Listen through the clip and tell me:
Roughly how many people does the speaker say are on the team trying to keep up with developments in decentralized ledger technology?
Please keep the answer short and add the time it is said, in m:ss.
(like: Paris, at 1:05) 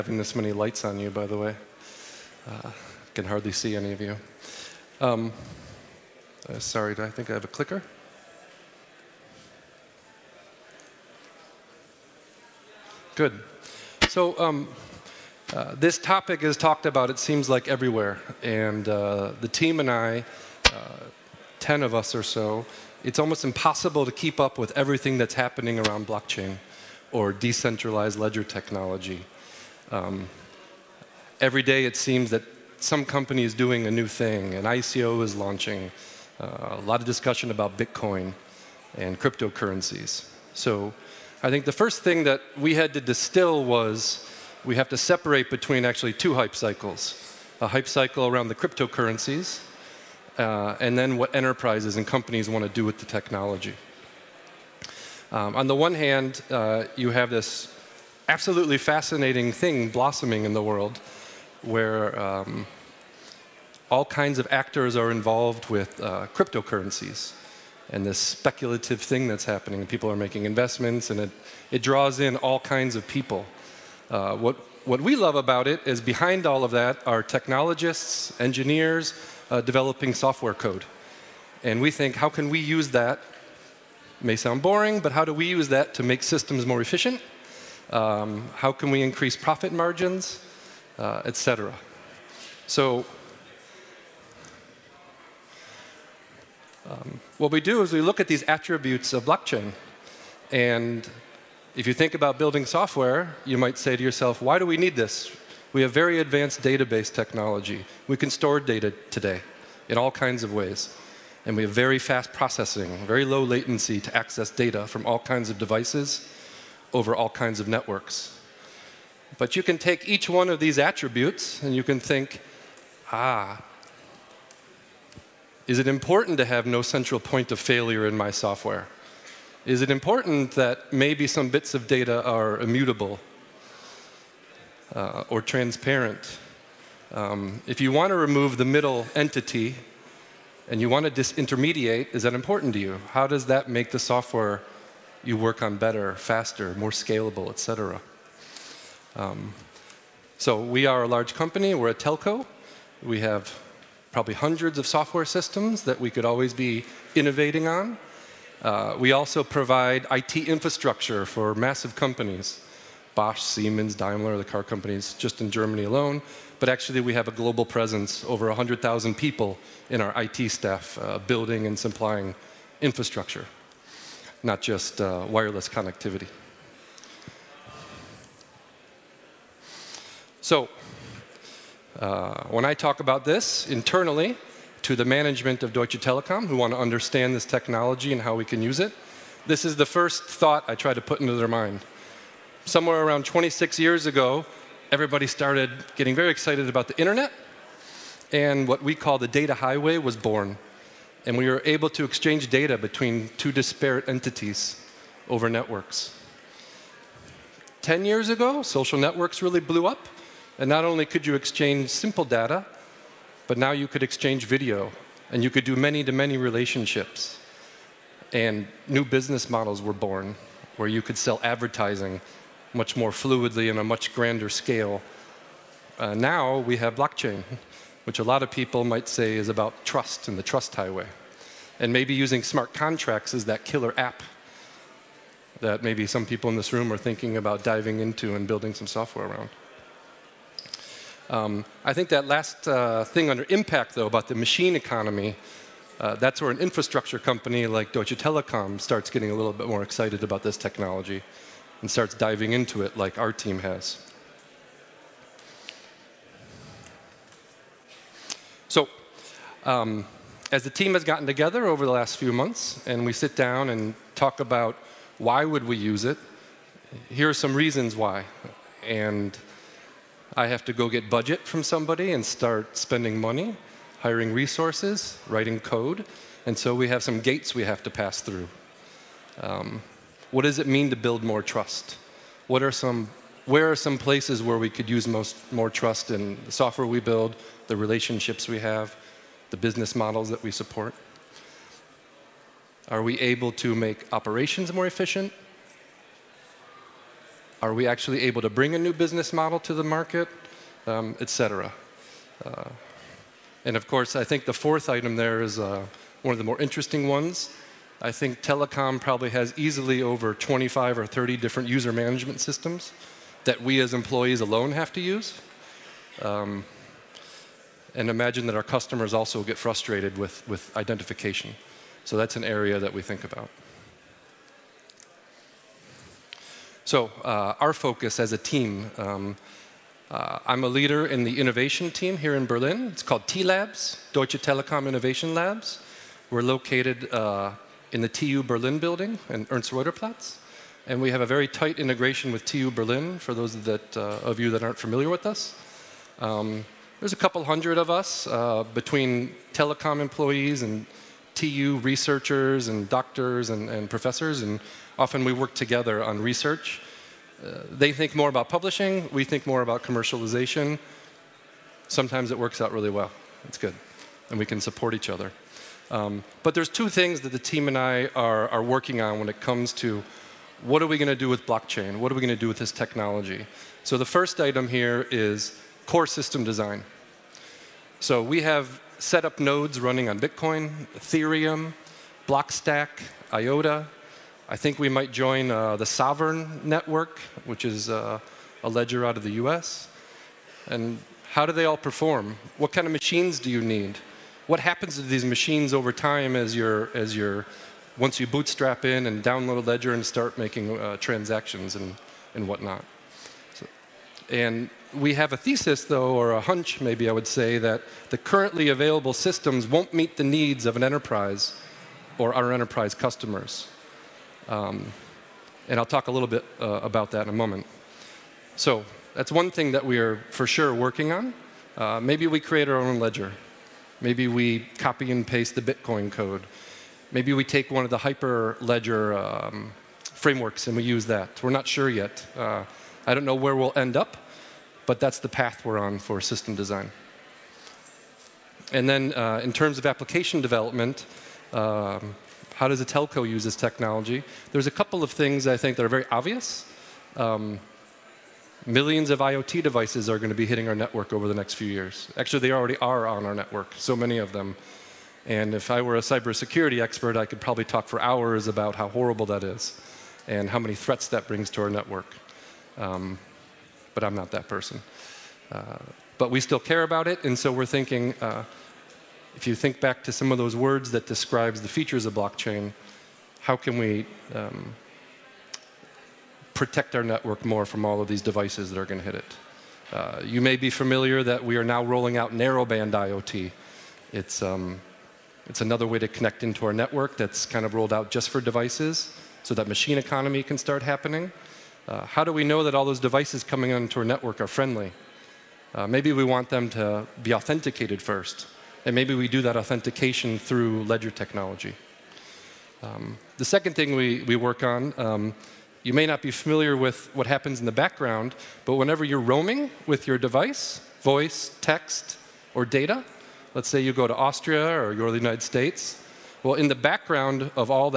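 10, at 0:21.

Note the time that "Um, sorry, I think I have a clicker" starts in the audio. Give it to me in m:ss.
0:04.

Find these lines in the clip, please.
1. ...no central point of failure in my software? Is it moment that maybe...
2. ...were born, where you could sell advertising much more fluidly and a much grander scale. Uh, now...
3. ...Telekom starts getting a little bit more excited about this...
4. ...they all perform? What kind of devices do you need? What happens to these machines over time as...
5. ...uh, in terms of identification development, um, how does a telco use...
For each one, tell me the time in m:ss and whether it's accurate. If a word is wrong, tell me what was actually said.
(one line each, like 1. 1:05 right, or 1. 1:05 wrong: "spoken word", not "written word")
1. 2:06 wrong: "important", not "moment"
2. 3:39 right
3. 4:08 right
4. 6:31 wrong: "machines", not "devices"
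5. 7:19 wrong: "application", not "identification".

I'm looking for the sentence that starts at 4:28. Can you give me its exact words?
And I have to go get budget from somebody and start spending money, hiring resources, writing code.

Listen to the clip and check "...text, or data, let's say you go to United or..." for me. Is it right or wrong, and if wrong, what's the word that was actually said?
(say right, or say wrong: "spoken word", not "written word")
wrong: "Austria", not "United".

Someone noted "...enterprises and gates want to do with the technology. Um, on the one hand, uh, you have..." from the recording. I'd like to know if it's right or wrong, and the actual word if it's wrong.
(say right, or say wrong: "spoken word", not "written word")
wrong: "companies", not "gates".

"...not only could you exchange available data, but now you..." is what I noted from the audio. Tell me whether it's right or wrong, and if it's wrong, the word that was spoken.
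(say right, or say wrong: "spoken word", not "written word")
wrong: "simple", not "available".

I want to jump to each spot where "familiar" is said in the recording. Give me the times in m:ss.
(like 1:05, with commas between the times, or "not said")
5:44, 8:00, 8:26.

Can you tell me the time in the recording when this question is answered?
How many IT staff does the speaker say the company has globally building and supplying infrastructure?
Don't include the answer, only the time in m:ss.
2:48.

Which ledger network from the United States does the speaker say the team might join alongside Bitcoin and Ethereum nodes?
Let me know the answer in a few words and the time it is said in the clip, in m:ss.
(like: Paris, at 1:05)
Sovrin Network, at 6:25.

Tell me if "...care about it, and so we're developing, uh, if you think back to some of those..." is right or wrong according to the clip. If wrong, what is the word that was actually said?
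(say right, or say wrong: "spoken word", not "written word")
wrong: "thinking", not "developing".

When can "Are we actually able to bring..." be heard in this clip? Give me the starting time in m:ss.
4:57.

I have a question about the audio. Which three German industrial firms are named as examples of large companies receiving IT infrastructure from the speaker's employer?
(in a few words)
Bosch, Siemens, Daimler.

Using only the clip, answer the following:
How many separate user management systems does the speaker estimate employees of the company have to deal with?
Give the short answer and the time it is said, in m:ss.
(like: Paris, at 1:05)
25 or 30, at 5:10.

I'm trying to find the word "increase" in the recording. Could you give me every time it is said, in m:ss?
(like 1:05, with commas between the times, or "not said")
1:29.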